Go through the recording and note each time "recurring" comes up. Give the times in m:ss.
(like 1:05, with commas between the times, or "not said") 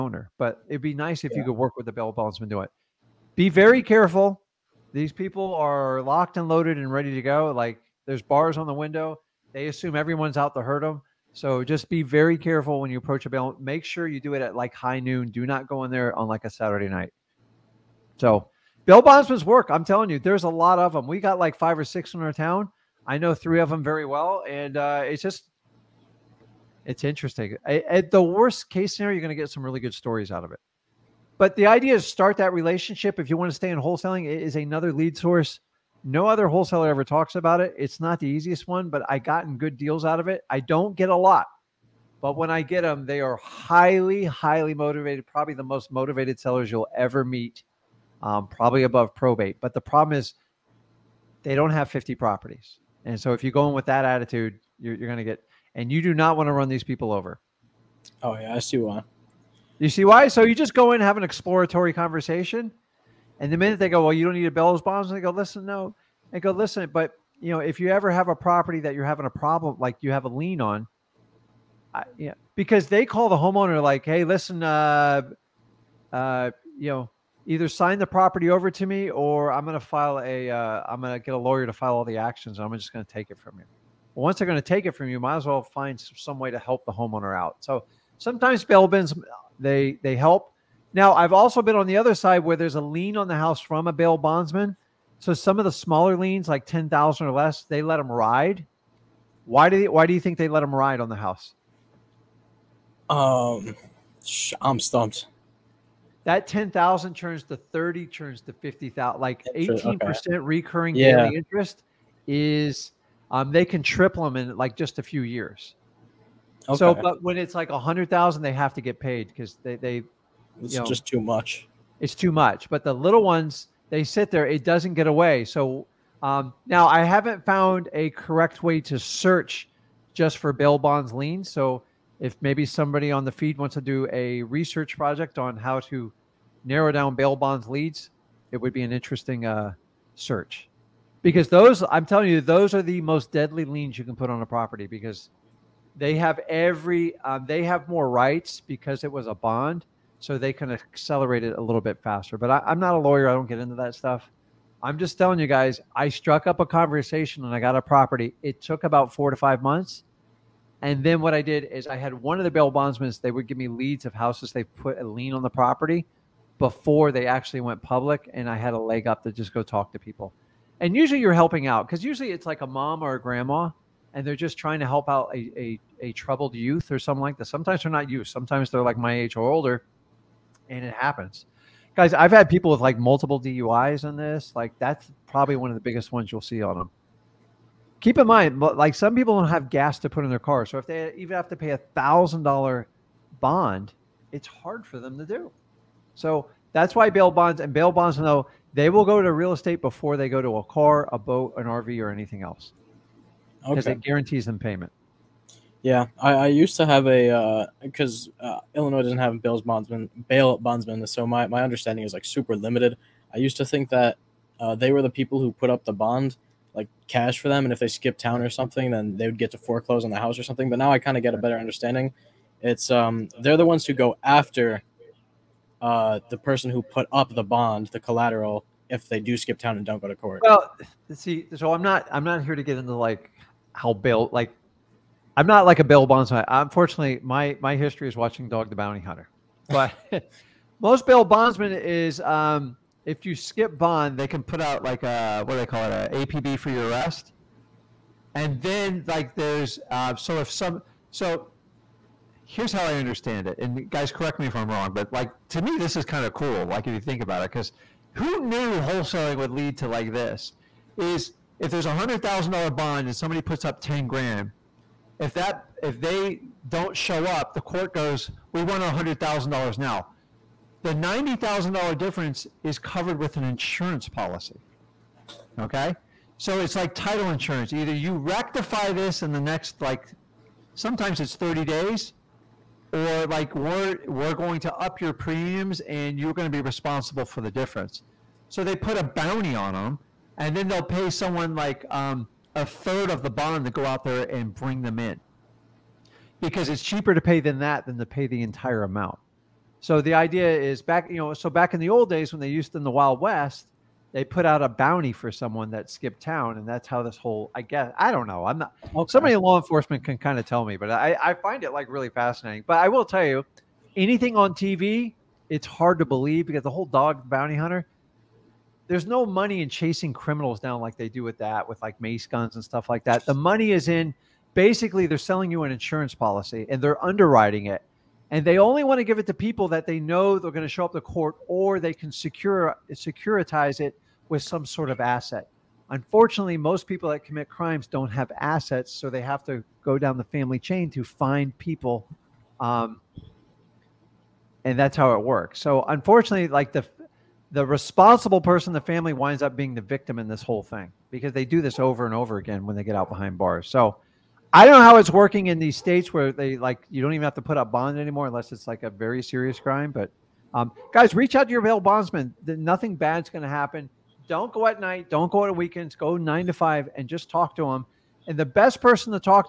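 1:50.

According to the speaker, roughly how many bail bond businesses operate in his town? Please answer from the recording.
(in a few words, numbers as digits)
5 or 6.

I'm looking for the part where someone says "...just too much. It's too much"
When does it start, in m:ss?
2:00.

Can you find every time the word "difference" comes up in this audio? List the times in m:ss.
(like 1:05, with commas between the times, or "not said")
4:31, 4:47.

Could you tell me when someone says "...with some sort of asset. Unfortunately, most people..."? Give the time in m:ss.
5:34.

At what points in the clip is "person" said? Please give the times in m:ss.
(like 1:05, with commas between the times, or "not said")
3:46, 5:48, 6:08.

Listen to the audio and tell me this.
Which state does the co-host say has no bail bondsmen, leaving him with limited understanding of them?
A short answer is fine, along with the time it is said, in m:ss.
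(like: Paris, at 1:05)
Illinois, at 3:28.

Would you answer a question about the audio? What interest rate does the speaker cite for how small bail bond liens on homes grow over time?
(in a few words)
18%.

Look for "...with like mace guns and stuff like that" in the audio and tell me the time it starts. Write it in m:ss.
5:21.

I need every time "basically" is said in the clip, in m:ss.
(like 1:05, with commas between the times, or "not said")
5:24.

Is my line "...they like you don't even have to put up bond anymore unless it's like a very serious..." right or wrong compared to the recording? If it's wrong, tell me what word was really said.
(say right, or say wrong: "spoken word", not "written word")
right.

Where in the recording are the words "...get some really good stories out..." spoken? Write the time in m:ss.
0:29.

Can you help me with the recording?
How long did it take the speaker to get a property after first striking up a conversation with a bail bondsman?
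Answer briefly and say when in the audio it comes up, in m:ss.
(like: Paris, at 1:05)
4 to 5 months, at 2:39.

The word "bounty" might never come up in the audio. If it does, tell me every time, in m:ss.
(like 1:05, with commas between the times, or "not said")
3:58, 4:49, 5:04, 5:17.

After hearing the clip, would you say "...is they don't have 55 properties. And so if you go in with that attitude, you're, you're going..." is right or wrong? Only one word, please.
wrong.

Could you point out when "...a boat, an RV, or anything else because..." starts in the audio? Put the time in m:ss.
3:21.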